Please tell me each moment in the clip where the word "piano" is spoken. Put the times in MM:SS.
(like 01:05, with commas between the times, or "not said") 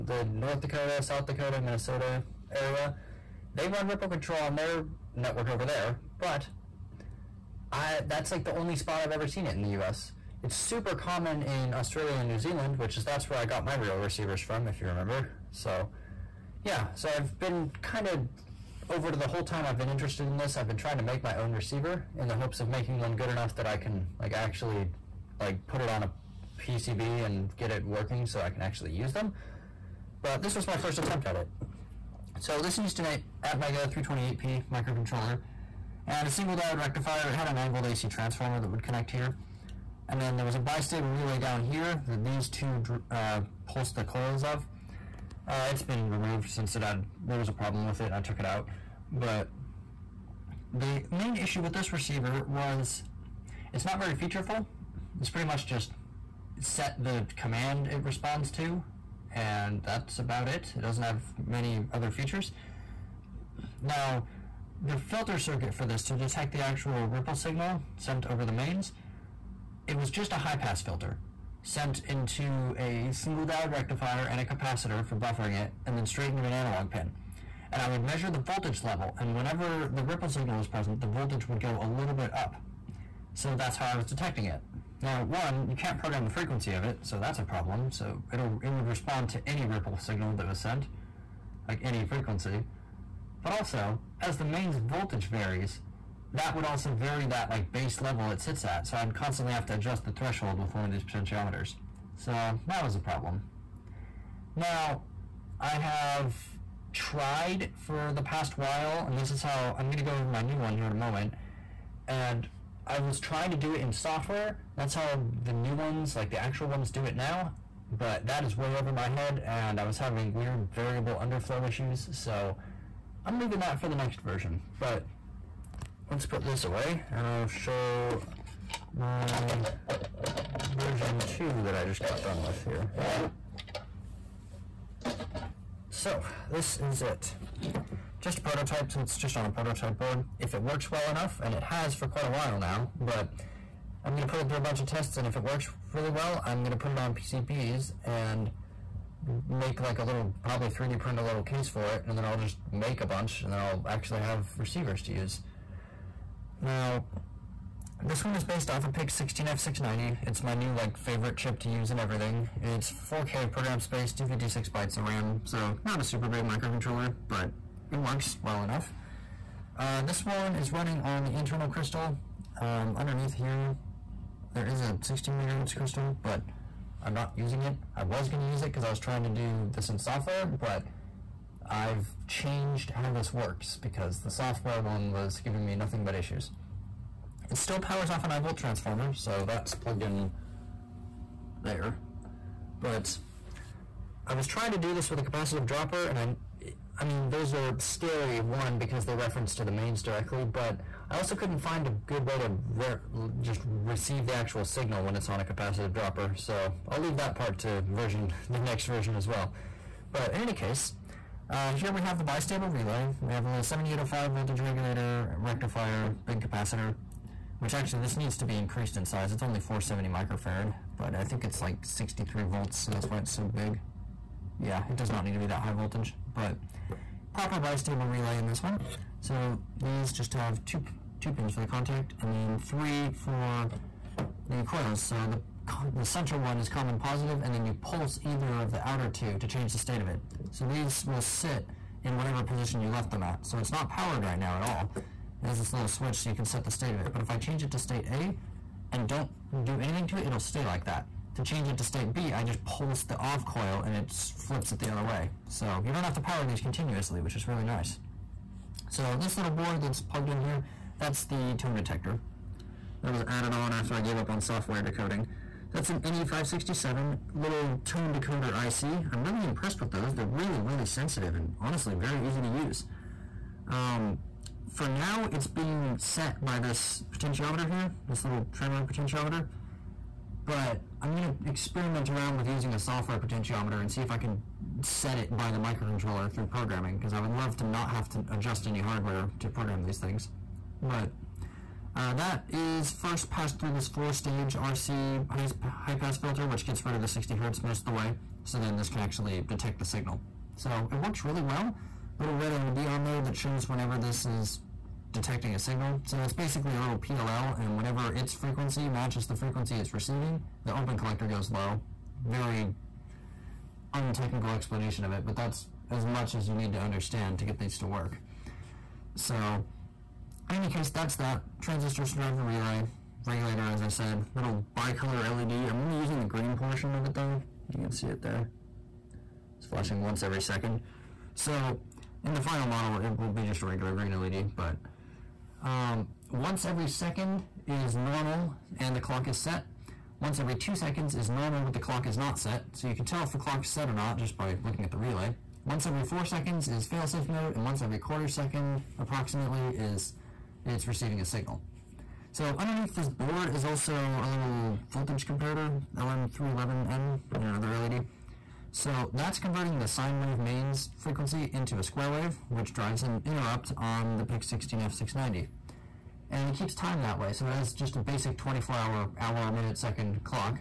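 not said.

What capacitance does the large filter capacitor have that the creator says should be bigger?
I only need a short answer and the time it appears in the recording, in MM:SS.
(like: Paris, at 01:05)
470 microfarad, at 03:39.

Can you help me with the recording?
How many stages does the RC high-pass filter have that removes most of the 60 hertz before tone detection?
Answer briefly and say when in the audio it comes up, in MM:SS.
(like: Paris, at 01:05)
4, at 04:53.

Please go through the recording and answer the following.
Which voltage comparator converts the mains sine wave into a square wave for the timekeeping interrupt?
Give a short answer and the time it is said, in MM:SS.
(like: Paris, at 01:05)
LM311N, at 05:55.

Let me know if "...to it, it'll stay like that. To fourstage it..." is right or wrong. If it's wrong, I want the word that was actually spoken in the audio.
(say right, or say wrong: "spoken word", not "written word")
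wrong: "change", not "fourstage".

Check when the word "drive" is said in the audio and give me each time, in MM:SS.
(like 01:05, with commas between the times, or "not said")
05:22, 06:02.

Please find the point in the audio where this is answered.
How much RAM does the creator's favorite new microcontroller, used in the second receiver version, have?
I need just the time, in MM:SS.
02:44.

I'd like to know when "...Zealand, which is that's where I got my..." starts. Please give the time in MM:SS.
00:12.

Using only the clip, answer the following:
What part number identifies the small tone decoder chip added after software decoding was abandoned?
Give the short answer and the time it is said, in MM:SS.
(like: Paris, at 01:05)
NE567, at 04:25.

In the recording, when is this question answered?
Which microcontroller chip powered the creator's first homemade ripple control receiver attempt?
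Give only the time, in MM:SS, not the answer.
00:33.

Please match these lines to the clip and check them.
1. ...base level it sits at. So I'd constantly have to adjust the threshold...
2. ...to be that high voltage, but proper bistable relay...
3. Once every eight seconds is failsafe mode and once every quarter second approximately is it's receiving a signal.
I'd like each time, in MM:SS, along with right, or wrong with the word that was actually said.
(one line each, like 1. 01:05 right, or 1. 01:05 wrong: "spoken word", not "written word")
1. 01:37 right
2. 03:45 right
3. 05:45 wrong: "four", not "eight".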